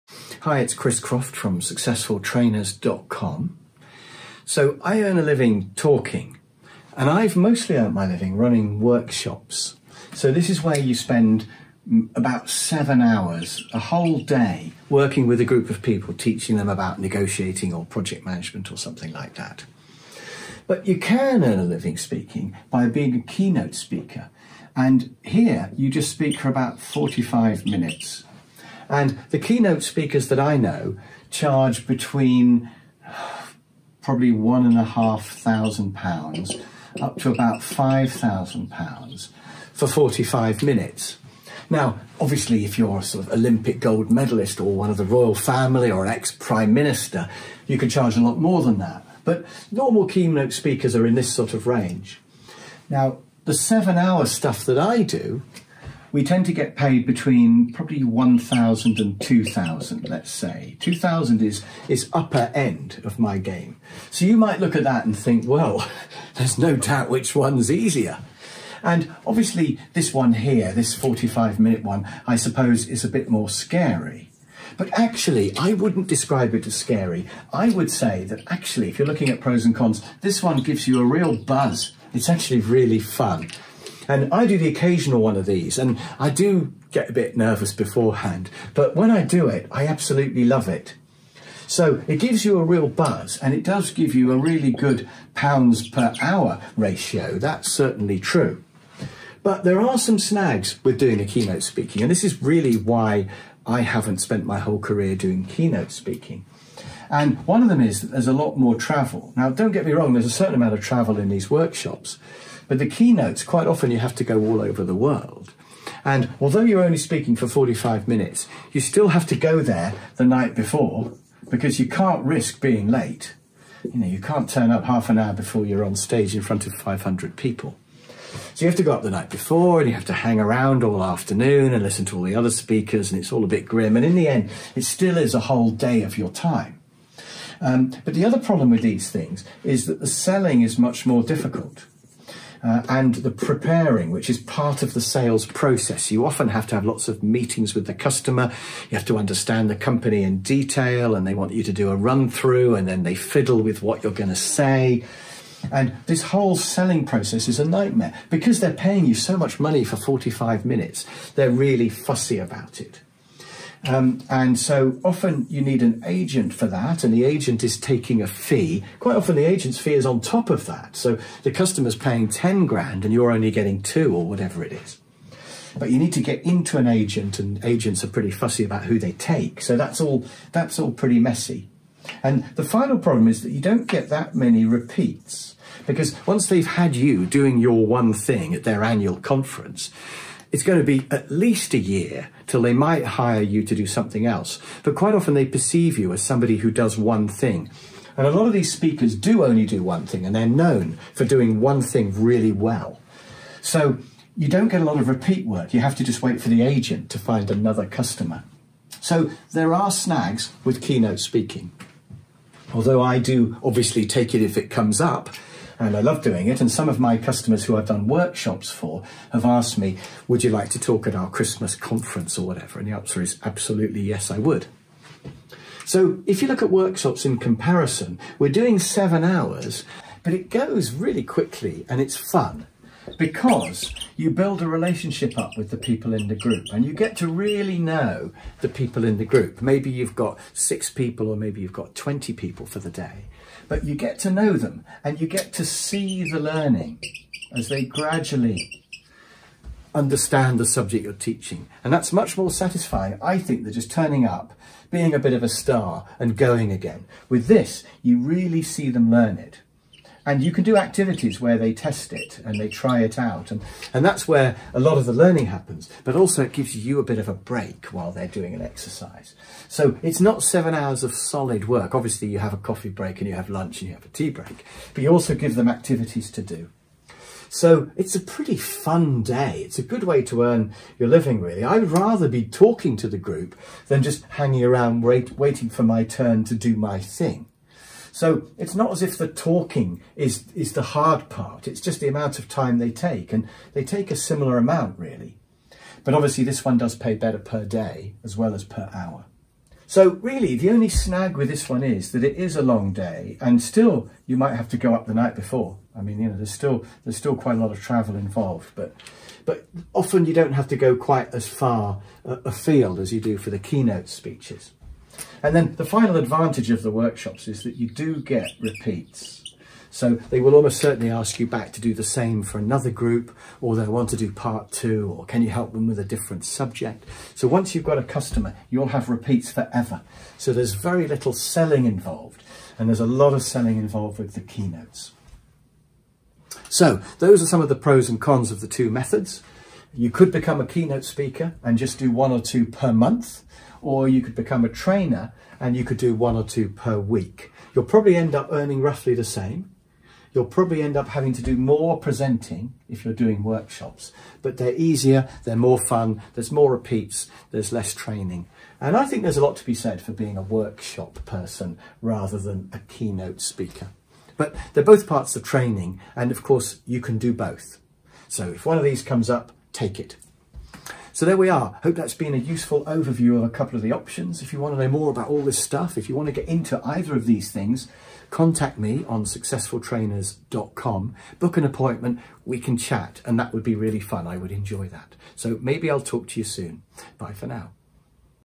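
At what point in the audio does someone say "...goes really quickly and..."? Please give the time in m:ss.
3:50.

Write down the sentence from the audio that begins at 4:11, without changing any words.
And that's much more satisfying, I think, than just turning up, being a bit of a star and going again.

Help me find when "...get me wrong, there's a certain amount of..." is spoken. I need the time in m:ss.
1:49.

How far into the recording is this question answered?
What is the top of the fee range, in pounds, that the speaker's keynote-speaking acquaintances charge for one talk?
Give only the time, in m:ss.
0:37.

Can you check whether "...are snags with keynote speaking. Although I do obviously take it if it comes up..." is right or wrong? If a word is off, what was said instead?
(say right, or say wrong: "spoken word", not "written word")
right.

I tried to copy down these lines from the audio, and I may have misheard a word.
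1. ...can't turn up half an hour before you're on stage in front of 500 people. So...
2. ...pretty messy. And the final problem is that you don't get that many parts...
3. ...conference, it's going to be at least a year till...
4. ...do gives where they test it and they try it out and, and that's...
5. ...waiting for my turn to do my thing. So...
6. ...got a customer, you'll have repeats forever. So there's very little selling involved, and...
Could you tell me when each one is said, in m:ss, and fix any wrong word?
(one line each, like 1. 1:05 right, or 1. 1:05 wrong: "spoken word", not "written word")
1. 2:04 right
2. 3:00 wrong: "repeats", not "parts"
3. 3:09 right
4. 4:20 wrong: "activities", not "gives"
5. 4:45 right
6. 5:27 right.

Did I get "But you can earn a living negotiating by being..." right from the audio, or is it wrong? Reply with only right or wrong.
wrong.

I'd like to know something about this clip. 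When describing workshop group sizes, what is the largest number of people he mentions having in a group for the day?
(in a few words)
20.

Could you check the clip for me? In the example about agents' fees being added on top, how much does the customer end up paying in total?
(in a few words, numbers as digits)
10 grand.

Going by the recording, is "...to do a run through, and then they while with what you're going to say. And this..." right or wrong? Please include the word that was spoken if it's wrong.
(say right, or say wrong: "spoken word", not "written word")
wrong: "fiddle", not "while".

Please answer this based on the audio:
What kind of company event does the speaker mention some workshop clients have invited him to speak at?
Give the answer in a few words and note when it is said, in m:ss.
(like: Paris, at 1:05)
Christmas conference, at 3:41.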